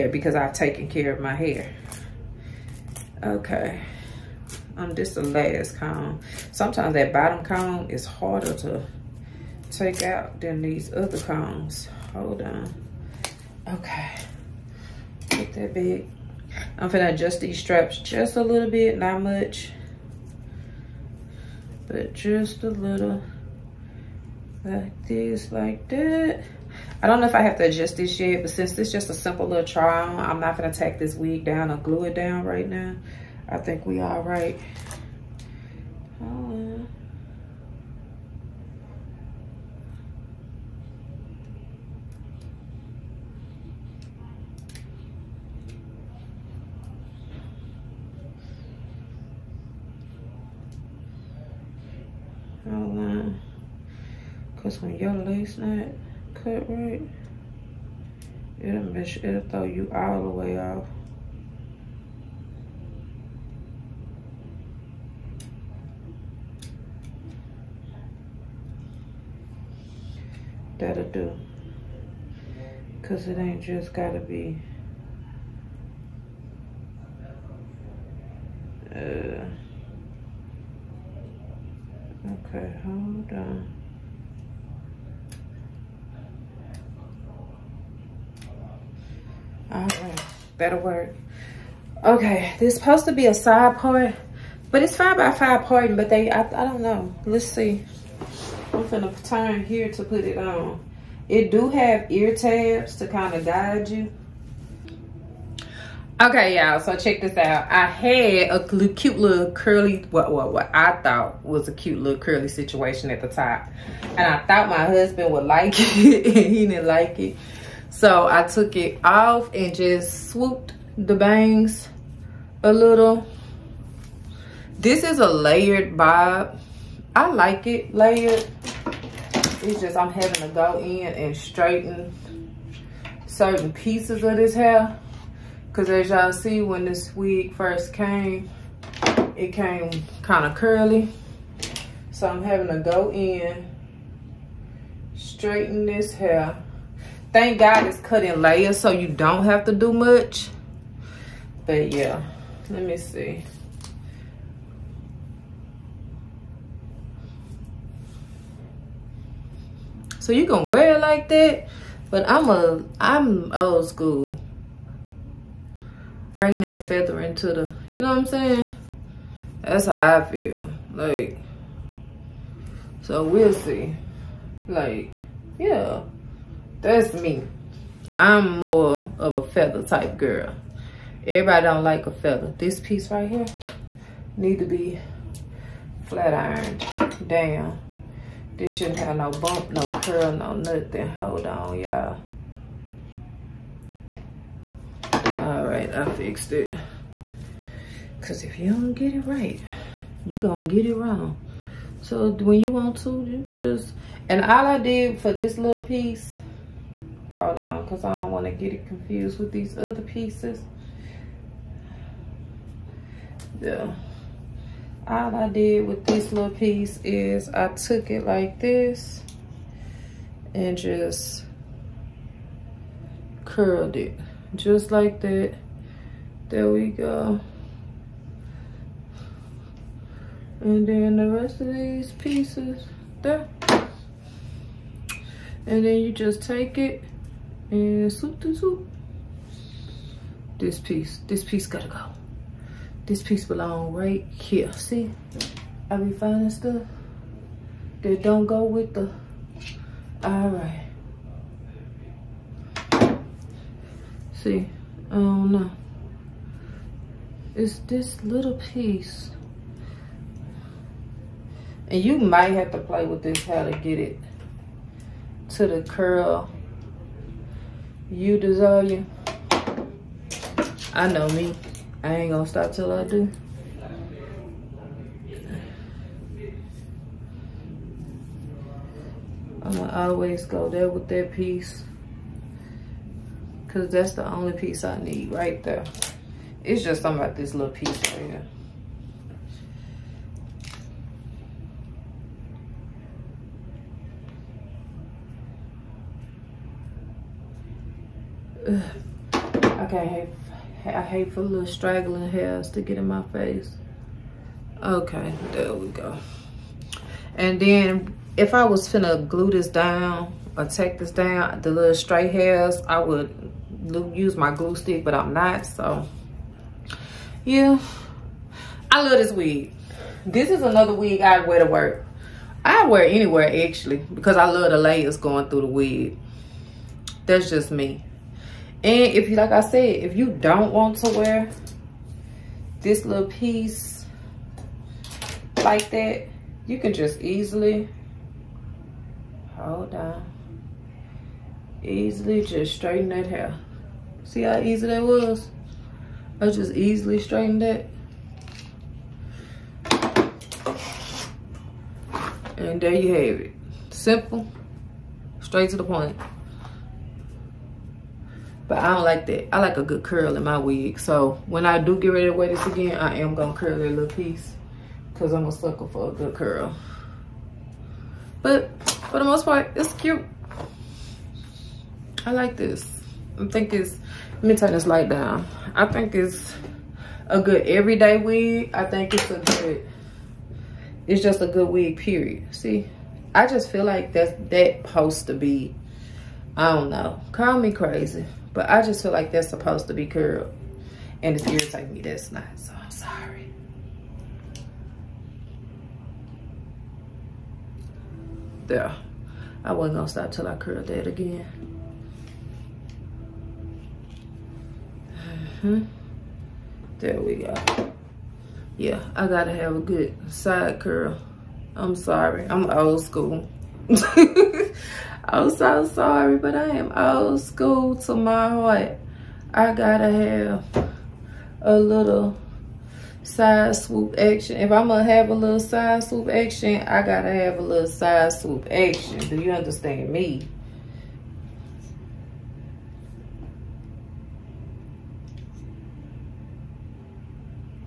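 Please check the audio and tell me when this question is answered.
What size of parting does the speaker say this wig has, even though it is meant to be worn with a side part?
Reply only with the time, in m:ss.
1:34.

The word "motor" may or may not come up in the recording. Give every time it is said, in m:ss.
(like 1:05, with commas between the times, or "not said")
not said.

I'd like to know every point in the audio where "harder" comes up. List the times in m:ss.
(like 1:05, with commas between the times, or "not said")
0:08.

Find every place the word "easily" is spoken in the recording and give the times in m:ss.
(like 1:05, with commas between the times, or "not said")
5:37, 5:41, 5:46.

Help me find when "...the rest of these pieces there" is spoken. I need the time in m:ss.
3:51.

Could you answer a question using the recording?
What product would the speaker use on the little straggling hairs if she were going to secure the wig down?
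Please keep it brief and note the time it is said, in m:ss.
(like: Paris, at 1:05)
Glue stick, at 5:14.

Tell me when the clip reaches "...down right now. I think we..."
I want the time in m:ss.
0:32.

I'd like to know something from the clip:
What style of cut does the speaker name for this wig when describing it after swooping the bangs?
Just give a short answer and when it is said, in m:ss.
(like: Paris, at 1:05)
Layered bob, at 2:05.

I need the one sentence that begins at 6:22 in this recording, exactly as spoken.
See, I just feel like that's that supposed to be, I don't know.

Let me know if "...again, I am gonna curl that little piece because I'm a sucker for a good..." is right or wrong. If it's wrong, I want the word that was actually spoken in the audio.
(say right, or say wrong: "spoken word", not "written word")
right.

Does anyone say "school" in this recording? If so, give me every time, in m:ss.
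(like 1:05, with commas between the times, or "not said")
2:43, 6:53, 6:57.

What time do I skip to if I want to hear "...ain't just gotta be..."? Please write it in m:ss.
1:13.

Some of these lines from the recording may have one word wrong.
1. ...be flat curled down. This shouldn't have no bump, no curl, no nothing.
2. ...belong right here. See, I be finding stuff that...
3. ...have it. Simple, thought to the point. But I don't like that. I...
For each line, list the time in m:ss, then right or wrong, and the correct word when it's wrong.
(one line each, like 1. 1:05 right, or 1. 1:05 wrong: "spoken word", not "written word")
1. 3:04 wrong: "ironed", not "curled"
2. 4:03 right
3. 5:53 wrong: "straight", not "thought".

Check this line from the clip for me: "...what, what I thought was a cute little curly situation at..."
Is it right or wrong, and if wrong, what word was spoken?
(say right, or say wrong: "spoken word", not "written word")
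right.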